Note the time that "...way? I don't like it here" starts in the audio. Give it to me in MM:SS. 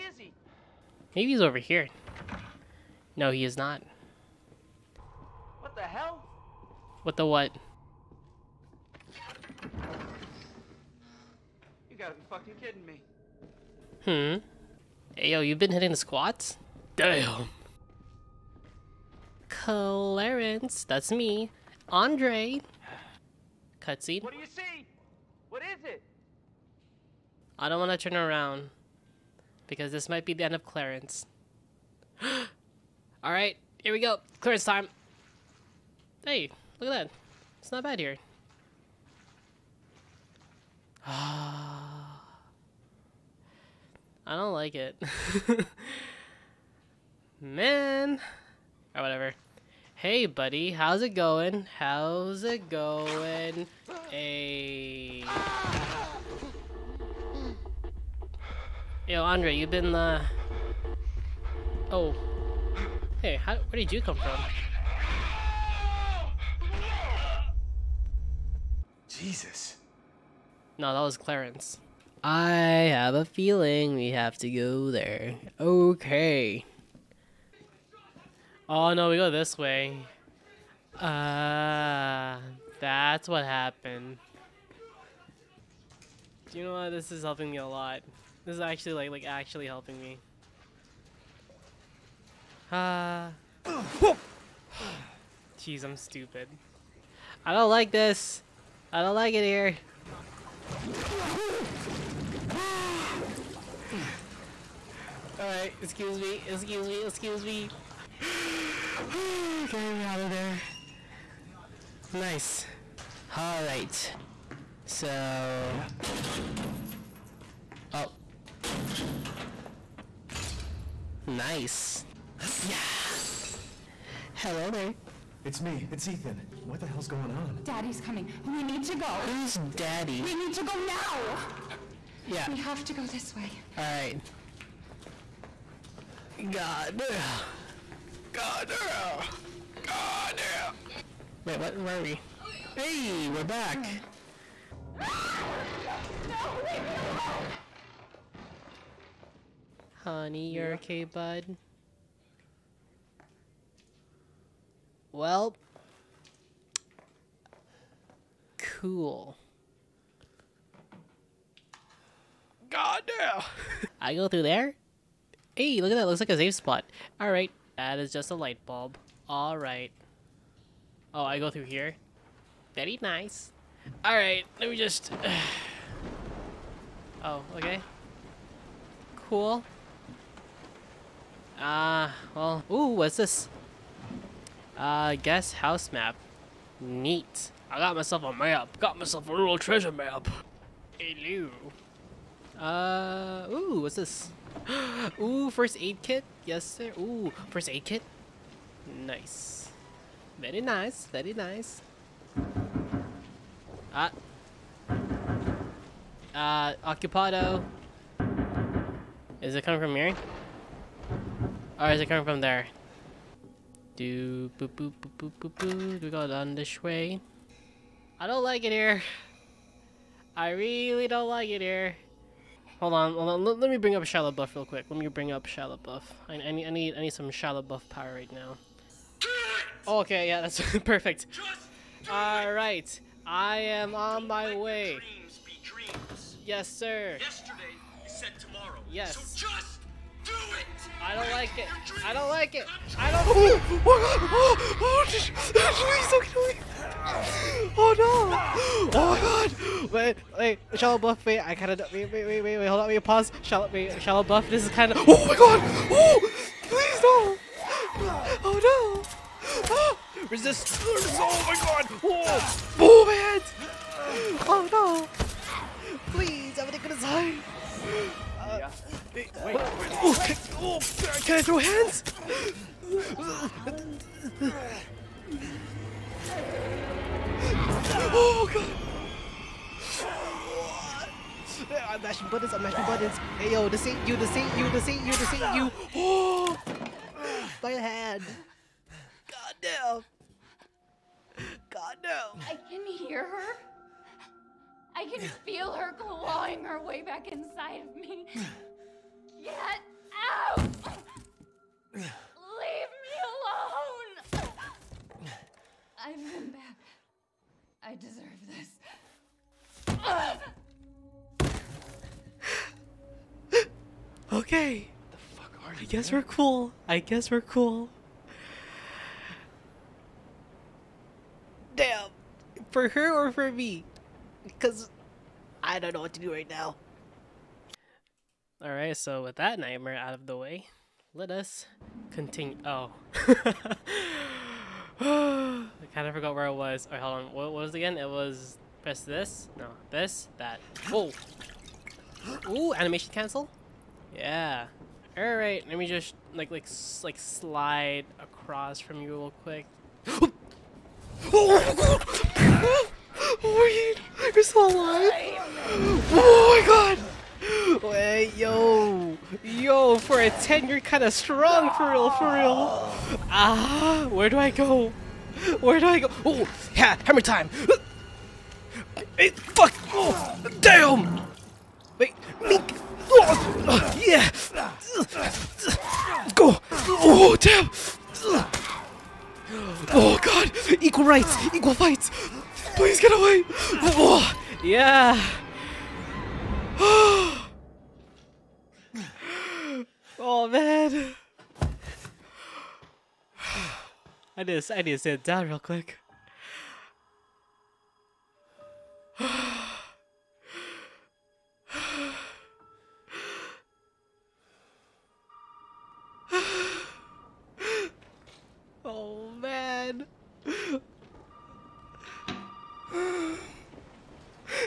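03:36.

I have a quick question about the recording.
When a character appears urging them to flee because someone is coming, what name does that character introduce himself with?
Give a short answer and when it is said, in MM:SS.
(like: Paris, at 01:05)
Ethan, at 02:06.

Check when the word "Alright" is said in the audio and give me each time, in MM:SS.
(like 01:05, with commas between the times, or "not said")
01:45, 01:53, 02:13, 05:28.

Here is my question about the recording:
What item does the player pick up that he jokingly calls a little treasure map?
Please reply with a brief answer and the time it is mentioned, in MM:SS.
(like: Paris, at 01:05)
guess house map, at 03:05.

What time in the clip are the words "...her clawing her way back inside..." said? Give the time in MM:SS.
04:55.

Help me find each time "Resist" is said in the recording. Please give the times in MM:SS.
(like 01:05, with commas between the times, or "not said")
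04:20.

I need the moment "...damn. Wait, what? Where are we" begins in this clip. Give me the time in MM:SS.
02:20.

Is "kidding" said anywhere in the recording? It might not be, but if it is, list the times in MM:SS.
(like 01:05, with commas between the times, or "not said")
00:12.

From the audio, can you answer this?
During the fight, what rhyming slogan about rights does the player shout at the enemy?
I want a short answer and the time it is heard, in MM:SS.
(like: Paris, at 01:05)
Equal fights, at 06:21.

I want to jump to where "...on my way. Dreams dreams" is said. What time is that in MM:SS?
03:53.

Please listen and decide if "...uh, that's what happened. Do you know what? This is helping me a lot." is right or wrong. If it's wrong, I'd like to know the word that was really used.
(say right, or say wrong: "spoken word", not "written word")
right.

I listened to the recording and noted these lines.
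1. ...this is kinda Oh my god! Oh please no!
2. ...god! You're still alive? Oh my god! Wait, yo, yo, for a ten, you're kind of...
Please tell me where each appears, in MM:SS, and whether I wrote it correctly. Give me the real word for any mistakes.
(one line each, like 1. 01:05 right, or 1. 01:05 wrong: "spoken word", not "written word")
1. 04:14 right
2. 05:53 right.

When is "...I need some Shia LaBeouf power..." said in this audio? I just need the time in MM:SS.
03:46.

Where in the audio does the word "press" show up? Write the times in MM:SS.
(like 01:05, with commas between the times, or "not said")
05:38.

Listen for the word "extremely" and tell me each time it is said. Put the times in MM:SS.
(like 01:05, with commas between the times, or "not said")
not said.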